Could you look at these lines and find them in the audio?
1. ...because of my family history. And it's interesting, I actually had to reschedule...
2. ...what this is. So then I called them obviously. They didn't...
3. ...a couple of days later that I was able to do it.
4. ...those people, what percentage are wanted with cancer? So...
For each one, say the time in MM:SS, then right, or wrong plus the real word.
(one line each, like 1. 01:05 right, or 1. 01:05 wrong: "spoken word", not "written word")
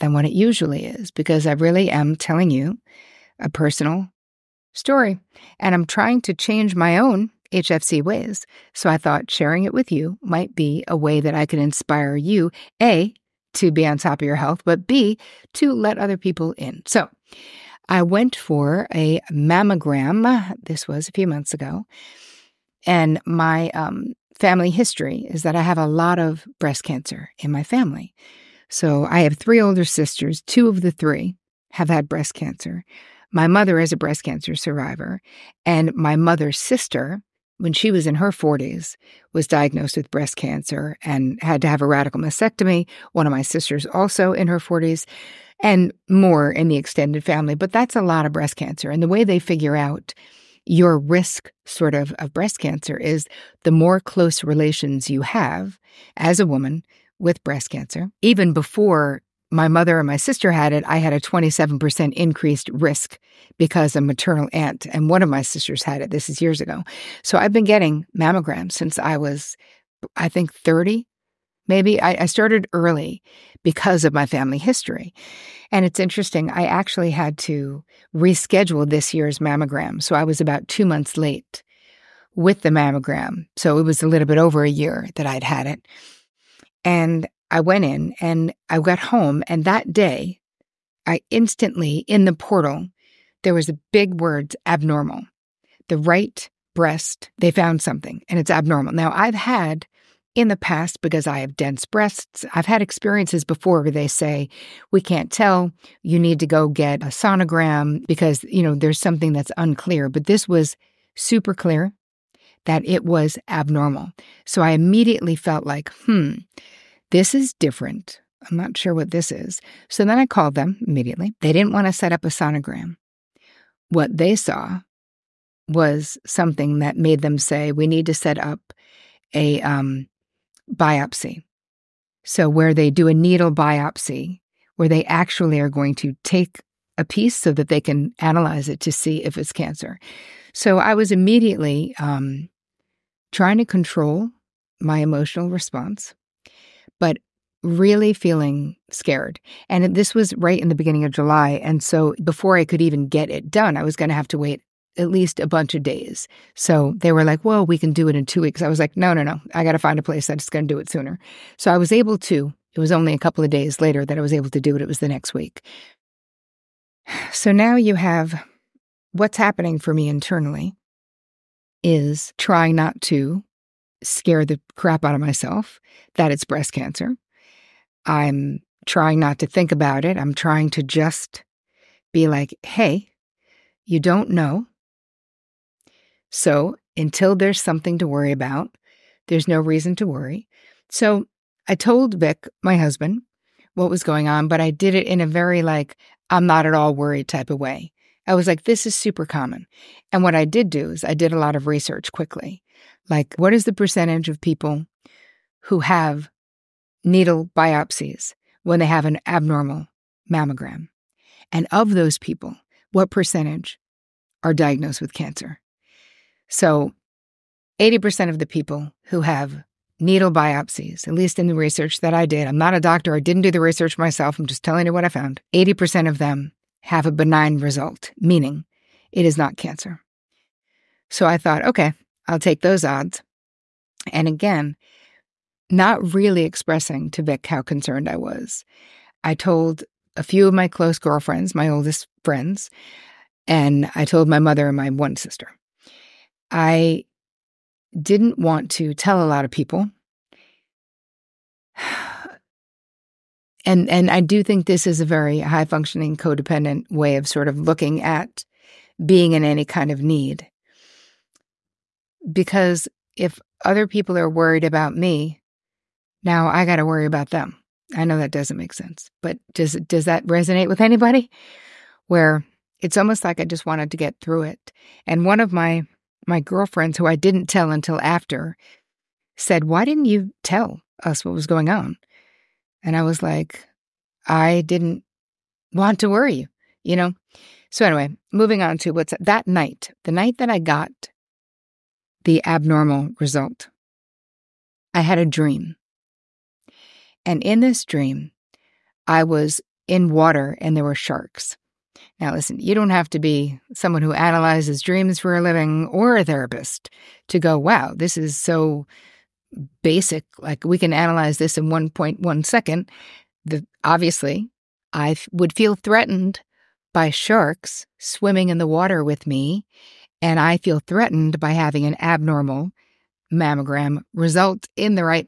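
1. 01:13 right
2. 01:58 wrong: "immediately", not "obviously"
3. 02:43 right
4. 03:31 wrong: "diagnosed", not "wanted".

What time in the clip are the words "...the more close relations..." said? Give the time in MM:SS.
00:53.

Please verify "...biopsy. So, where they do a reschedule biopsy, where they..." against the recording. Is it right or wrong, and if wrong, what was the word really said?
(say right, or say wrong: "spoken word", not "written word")
wrong: "needle", not "reschedule".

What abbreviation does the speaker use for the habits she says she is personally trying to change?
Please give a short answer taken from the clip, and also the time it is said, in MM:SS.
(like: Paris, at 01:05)
HFC, at 00:07.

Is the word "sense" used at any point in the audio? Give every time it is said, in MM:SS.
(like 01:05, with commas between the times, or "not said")
04:28.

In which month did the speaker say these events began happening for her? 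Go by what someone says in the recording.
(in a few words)
July.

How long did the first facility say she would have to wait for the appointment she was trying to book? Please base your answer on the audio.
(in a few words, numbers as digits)
2 weeks.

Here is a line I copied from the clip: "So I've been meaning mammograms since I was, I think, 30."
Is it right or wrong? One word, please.
wrong.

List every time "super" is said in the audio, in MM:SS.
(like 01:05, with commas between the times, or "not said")
01:51, 03:18.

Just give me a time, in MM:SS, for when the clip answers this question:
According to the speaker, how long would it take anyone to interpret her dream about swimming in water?
05:11.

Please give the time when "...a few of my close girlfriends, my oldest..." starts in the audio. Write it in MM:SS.
04:00.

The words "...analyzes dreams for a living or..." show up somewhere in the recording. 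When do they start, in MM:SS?
05:04.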